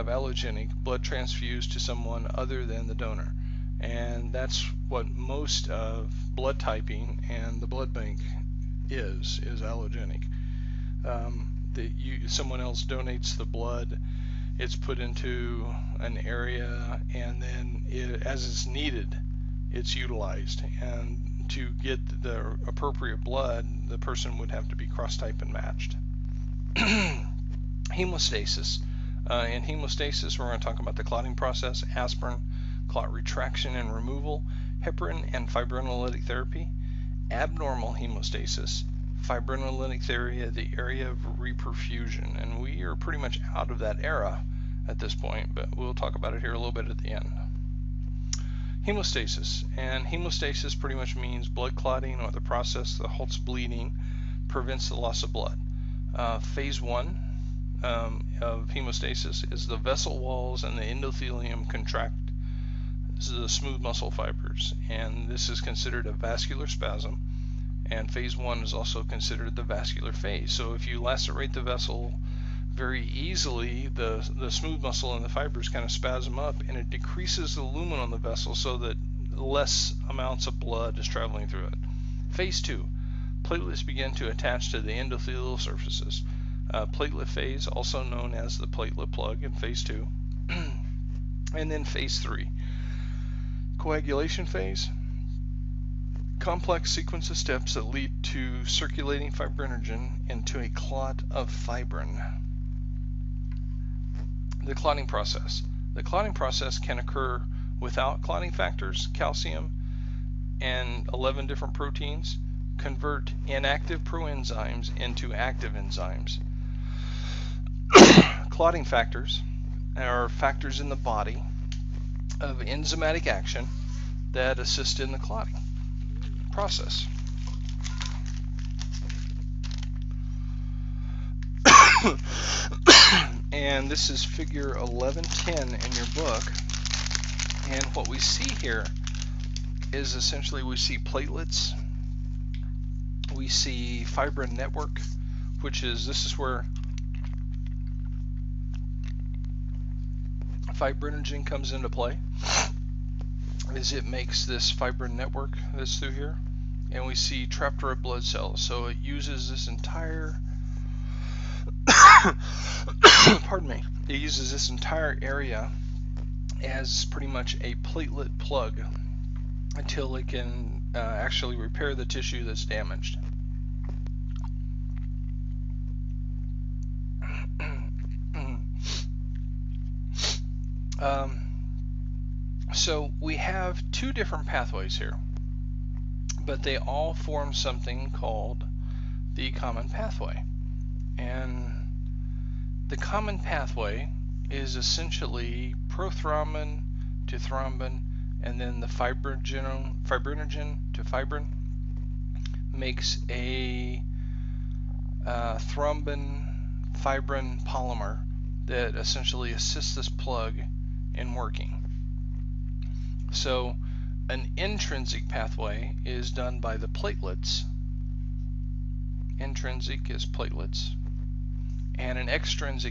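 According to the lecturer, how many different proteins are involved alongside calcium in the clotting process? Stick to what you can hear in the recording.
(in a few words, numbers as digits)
11.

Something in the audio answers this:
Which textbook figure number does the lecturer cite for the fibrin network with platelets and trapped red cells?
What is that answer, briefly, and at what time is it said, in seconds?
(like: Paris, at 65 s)
figure 1110, at 134 s.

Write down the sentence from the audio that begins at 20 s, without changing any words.
And to get the appropriate blood, the person would have to be cross-type and matched.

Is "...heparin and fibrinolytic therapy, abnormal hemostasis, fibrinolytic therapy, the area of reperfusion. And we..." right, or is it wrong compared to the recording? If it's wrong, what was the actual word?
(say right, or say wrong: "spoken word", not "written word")
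right.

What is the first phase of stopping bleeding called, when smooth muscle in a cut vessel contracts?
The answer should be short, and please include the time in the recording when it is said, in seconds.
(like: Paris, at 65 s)
vascular phase, at 69 s.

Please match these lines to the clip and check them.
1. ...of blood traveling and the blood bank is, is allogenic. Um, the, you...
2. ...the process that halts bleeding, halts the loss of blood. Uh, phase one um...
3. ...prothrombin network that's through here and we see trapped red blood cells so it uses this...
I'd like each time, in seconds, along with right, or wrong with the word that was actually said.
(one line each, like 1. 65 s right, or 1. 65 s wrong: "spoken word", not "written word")
1. 5 s wrong: "typing", not "traveling"
2. 52 s wrong: "prevents", not "halts"
3. 154 s wrong: "fibrin", not "prothrombin".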